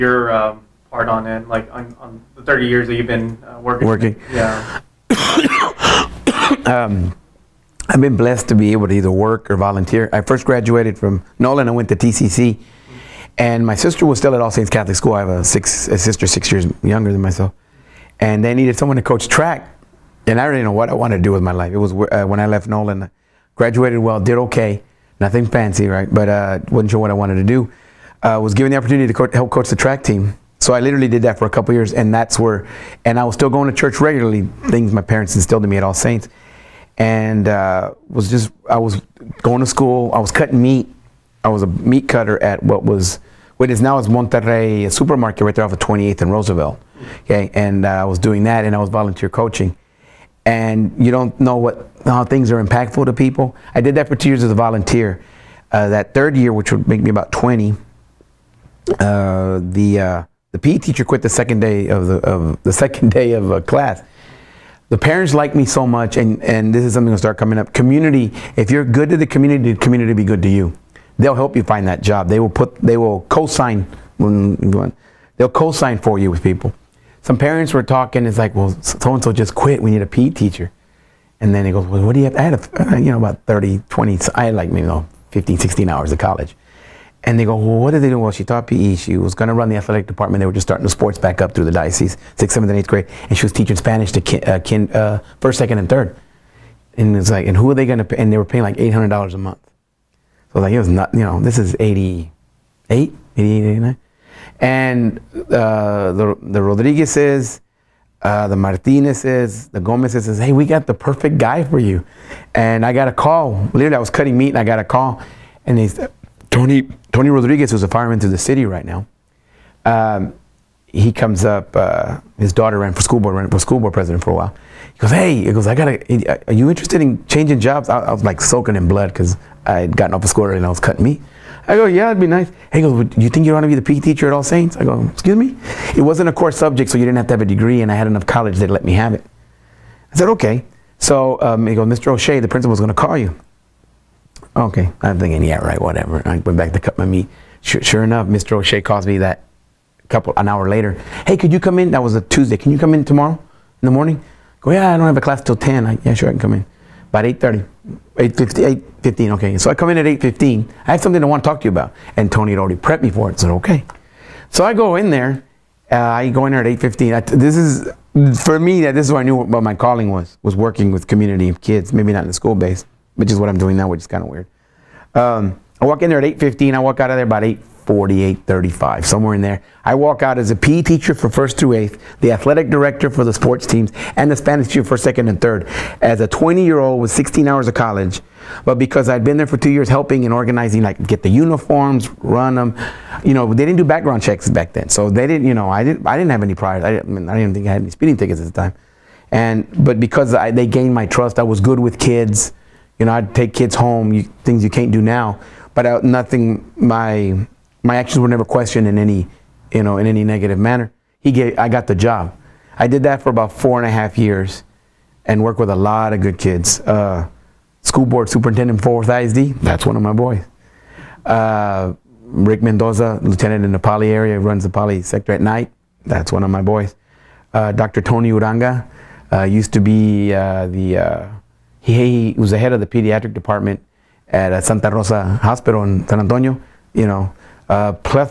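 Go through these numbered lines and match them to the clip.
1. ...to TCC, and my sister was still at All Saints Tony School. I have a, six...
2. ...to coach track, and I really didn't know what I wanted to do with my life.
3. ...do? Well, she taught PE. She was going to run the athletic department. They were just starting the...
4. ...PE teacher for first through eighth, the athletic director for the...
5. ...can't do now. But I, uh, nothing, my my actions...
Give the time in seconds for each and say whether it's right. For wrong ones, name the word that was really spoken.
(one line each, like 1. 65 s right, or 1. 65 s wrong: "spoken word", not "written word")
1. 11 s wrong: "Catholic", not "Tony"
2. 18 s right
3. 88 s right
4. 180 s right
5. 204 s right.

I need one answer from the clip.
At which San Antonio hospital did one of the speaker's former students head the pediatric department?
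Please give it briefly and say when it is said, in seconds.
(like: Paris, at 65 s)
Santa Rosa Hospital, at 234 s.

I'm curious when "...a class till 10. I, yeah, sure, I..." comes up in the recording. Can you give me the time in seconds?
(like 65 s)
155 s.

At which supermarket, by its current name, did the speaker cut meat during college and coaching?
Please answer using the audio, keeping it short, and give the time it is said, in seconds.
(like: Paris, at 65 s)
Monterrey, at 44 s.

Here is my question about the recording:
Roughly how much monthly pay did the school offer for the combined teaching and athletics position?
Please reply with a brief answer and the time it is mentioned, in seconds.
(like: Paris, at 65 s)
$800, at 98 s.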